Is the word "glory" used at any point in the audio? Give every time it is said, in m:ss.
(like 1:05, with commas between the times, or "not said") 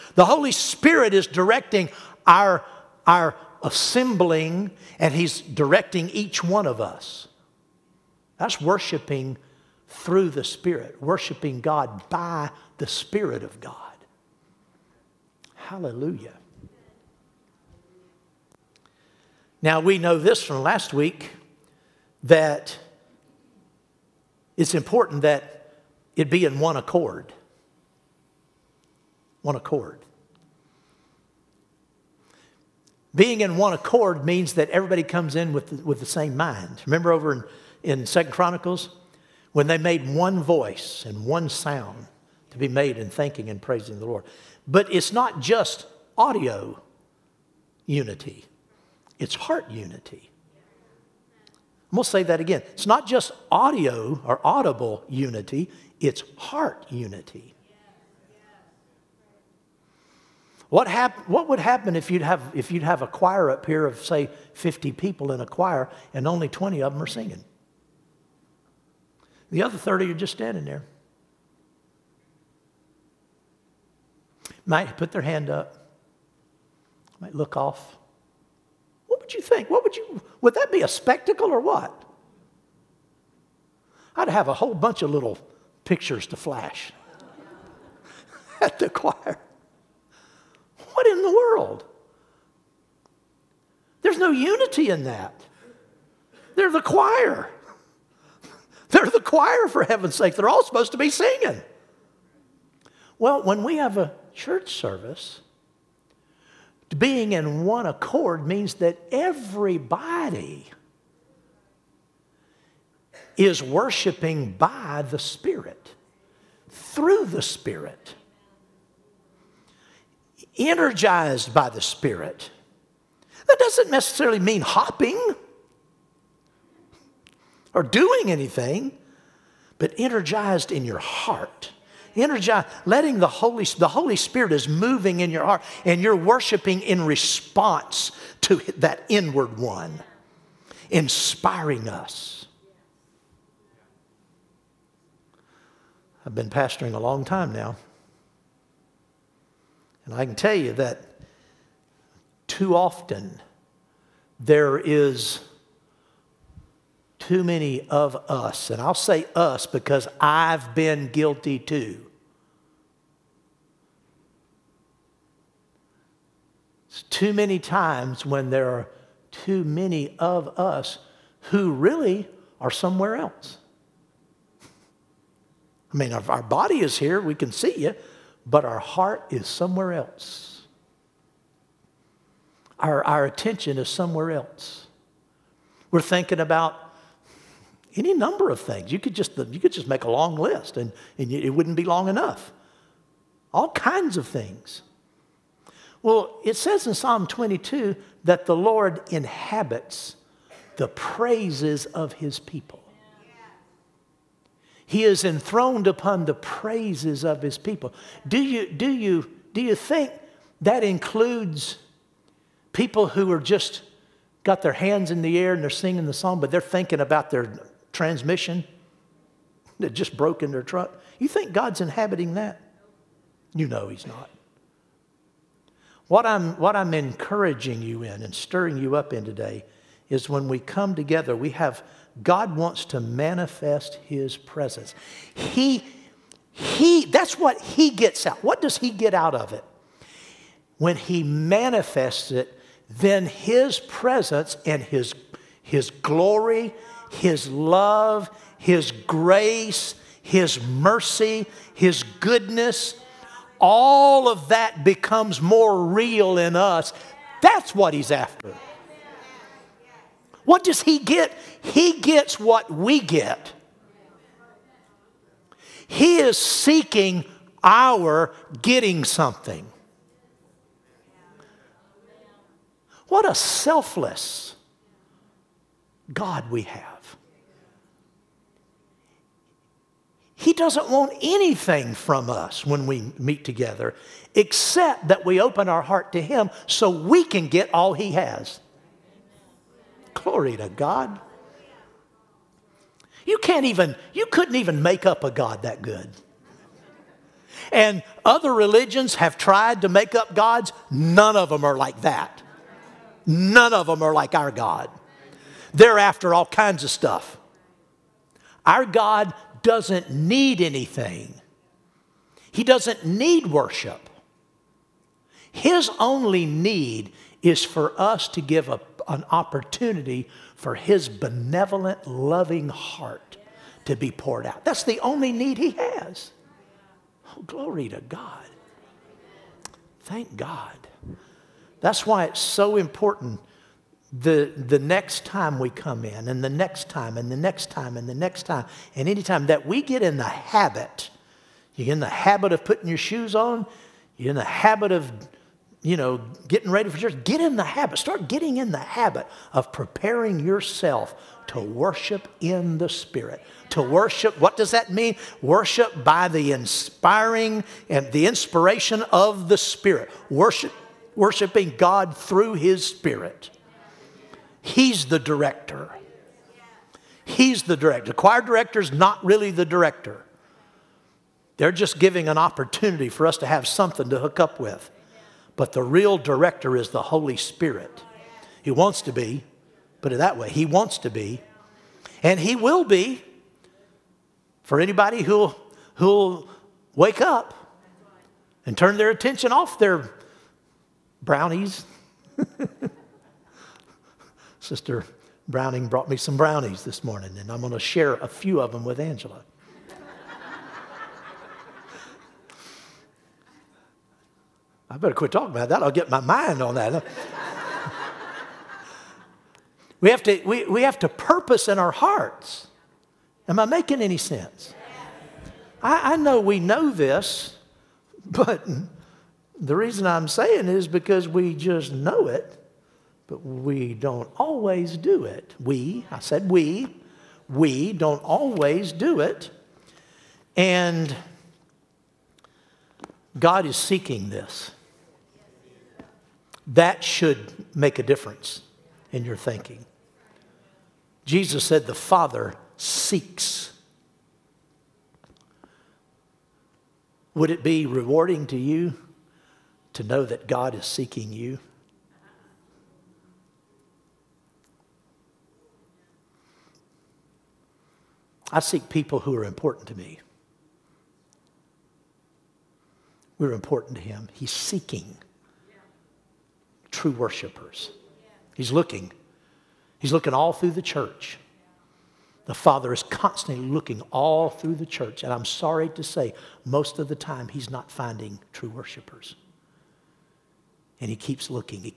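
4:05, 4:50, 5:27.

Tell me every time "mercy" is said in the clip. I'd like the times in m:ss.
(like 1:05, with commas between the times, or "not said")
4:10.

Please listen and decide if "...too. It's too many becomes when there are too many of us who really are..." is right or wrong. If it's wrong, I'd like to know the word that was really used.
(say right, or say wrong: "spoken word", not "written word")
wrong: "times", not "becomes".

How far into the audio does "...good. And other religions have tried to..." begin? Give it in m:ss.
4:55.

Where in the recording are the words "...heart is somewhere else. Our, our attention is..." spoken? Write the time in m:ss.
2:58.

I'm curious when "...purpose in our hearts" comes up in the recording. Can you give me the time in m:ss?
6:51.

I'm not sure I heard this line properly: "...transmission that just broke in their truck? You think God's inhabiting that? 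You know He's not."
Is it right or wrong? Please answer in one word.
right.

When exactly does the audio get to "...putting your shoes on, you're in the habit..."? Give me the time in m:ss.
5:42.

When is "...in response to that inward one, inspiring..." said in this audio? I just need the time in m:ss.
2:16.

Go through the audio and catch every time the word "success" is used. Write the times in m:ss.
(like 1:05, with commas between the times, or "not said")
not said.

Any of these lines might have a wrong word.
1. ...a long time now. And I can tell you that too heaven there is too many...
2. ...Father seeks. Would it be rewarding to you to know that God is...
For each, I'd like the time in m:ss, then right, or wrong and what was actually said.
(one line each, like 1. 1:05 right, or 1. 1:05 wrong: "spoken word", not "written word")
1. 2:26 wrong: "often", not "heaven"
2. 7:21 right.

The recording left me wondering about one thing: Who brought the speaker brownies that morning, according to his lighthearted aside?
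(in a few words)
Sister Browning.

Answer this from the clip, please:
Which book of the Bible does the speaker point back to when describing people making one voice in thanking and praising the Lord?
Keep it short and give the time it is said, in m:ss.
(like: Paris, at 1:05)
Second Chronicles, at 0:38.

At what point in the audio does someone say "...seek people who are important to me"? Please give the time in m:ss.
7:38.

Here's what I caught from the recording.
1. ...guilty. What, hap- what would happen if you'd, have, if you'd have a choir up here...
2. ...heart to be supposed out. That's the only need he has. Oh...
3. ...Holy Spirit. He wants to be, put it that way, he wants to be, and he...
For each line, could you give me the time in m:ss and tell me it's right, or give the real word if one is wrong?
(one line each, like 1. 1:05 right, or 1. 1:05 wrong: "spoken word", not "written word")
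1. 0:56 wrong: "unity", not "guilty"
2. 5:22 wrong: "poured", not "supposed"
3. 6:17 right.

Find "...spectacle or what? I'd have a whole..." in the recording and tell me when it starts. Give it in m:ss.
1:20.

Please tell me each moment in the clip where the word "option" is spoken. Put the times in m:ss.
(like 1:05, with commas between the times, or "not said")
not said.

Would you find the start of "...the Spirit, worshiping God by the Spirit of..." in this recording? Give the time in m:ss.
0:10.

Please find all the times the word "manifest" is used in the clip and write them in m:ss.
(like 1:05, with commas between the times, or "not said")
3:52, 4:01.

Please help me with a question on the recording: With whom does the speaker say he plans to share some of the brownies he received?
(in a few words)
Angela.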